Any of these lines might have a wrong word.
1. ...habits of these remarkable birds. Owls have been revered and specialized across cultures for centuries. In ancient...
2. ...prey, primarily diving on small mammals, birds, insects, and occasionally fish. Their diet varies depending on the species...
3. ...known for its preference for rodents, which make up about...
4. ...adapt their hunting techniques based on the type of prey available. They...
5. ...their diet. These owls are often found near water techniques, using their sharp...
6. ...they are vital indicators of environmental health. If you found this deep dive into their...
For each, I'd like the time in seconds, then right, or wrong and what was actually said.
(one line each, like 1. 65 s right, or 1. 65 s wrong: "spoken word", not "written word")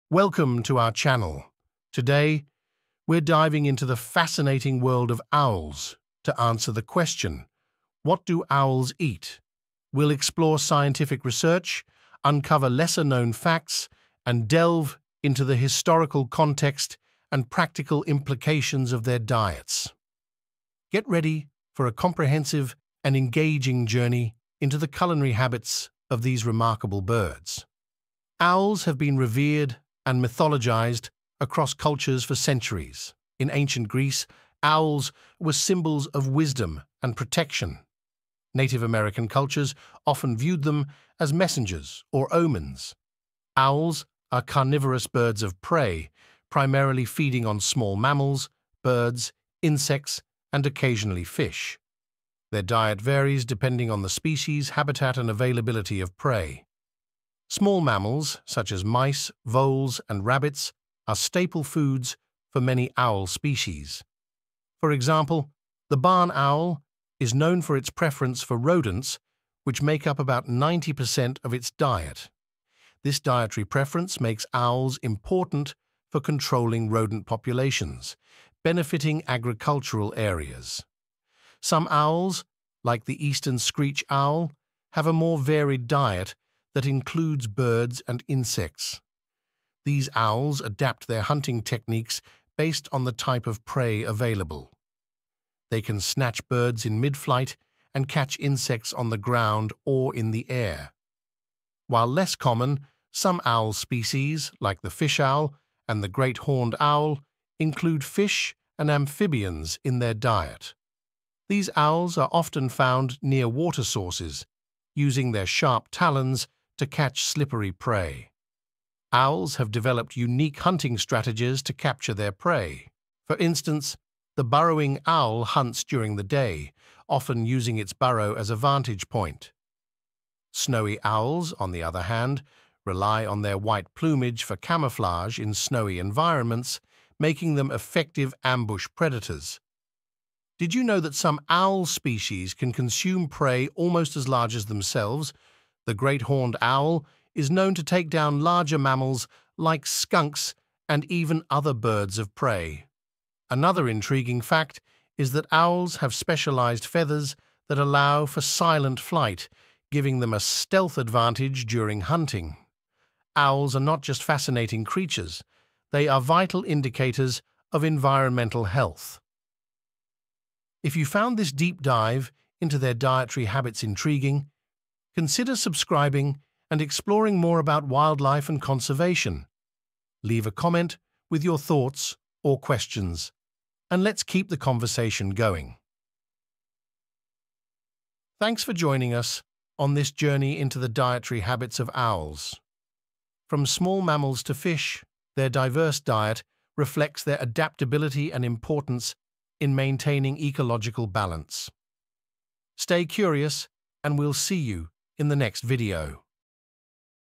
1. 25 s wrong: "mythologized", not "specialized"
2. 45 s wrong: "feeding", not "diving"
3. 67 s right
4. 90 s right
5. 109 s wrong: "sources", not "techniques"
6. 165 s right.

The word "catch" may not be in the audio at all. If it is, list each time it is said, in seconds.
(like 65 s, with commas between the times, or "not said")
98 s, 116 s.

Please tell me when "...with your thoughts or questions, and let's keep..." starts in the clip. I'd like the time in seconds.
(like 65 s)
181 s.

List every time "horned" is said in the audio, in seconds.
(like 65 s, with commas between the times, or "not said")
106 s, 146 s.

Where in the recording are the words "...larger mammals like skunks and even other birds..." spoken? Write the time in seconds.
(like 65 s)
148 s.